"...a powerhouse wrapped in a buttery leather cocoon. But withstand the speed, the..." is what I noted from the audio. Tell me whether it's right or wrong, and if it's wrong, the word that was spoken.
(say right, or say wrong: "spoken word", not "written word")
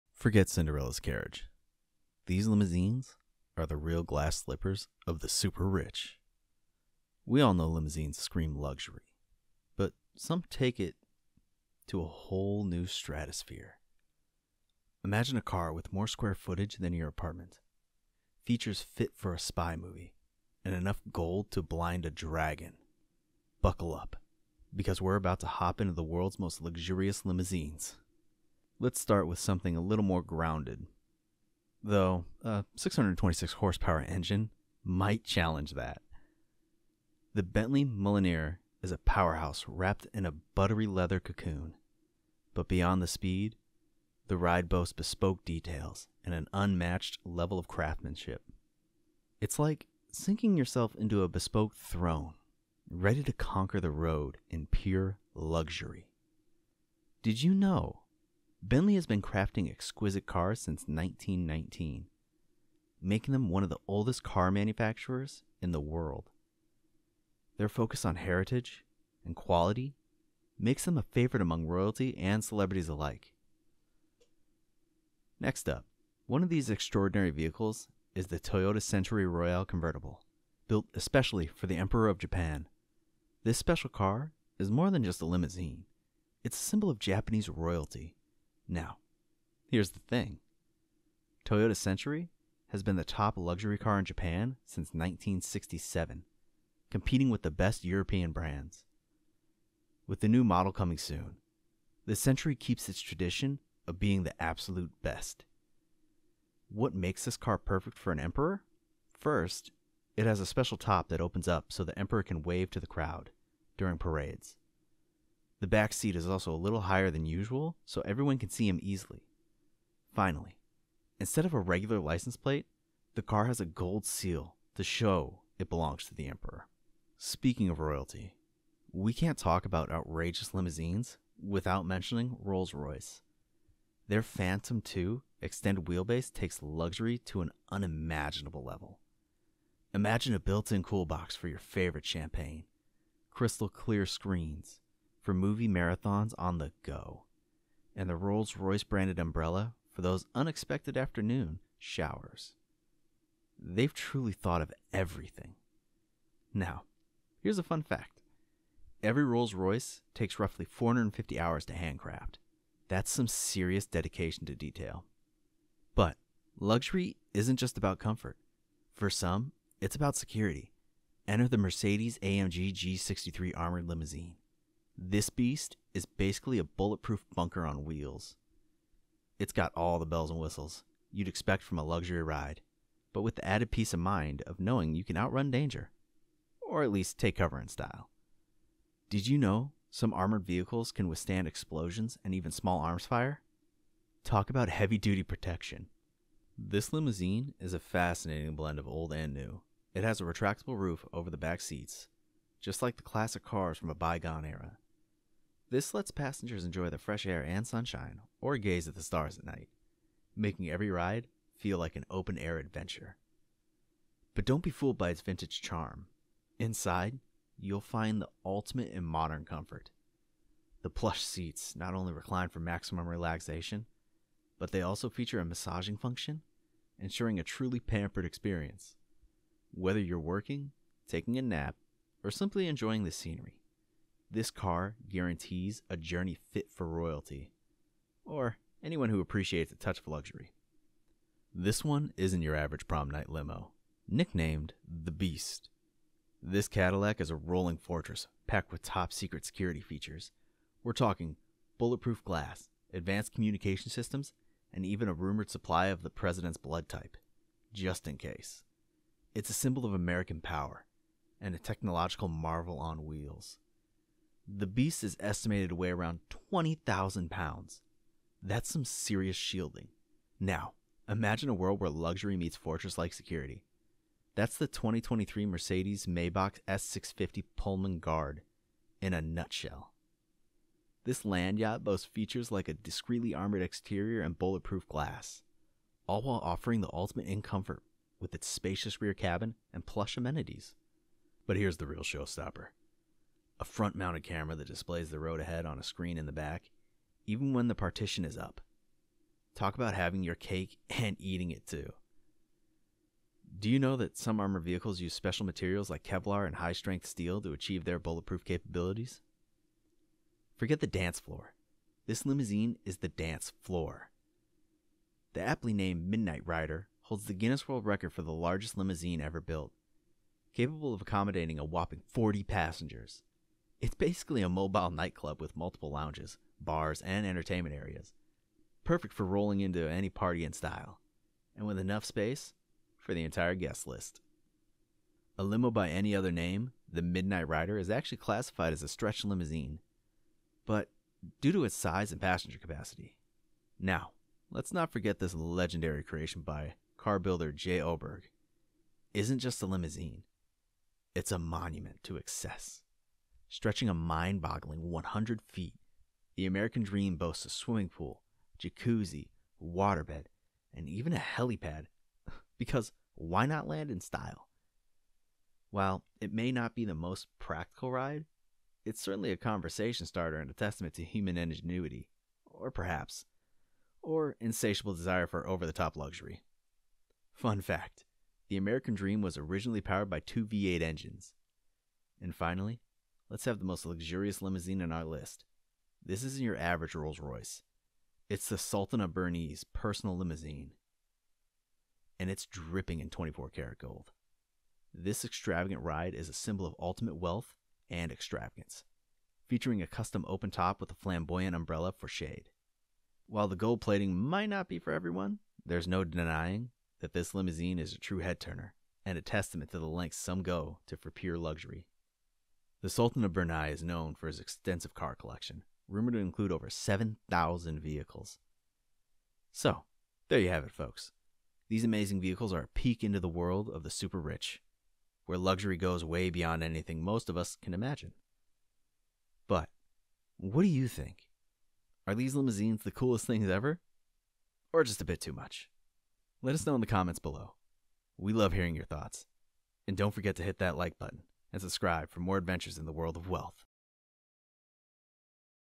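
wrong: "beyond", not "withstand".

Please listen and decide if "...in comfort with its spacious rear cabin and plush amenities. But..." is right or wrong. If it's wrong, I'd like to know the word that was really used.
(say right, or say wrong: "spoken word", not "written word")
right.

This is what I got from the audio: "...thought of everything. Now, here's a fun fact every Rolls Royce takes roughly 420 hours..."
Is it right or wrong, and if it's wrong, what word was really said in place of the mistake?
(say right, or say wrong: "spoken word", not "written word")
wrong: "450", not "420".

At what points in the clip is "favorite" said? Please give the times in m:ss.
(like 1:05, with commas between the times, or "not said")
1:11, 2:21.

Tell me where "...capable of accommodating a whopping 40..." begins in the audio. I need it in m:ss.
5:20.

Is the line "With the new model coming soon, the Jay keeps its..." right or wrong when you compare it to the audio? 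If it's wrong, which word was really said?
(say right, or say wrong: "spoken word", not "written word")
wrong: "Century", not "Jay".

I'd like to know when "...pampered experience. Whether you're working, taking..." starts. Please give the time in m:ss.
3:47.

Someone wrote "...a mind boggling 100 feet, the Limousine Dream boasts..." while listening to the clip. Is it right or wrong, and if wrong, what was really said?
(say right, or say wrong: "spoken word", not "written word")
wrong: "American", not "Limousine".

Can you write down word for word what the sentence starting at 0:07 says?
We all know limousines scream luxury, but some take it to a whole new stratosphere.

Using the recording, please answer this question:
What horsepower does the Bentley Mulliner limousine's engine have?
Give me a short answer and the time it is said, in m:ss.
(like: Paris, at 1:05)
626, at 0:32.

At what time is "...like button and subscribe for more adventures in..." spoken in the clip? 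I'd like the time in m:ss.
7:20.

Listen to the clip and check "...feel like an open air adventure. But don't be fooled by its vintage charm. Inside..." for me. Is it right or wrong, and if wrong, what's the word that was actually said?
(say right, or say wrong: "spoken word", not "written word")
right.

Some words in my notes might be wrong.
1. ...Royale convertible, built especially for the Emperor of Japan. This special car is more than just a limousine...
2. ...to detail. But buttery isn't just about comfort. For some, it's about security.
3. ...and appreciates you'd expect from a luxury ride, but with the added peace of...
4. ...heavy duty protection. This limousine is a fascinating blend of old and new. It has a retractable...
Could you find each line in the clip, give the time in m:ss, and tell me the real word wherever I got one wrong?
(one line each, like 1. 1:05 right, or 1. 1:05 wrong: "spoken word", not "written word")
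1. 1:19 right
2. 2:44 wrong: "luxury", not "buttery"
3. 3:00 wrong: "whistles", not "appreciates"
4. 3:14 right.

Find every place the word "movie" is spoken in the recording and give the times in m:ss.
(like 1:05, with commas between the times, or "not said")
0:19, 2:25.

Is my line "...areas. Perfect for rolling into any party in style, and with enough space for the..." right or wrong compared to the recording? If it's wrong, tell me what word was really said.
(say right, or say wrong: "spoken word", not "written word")
right.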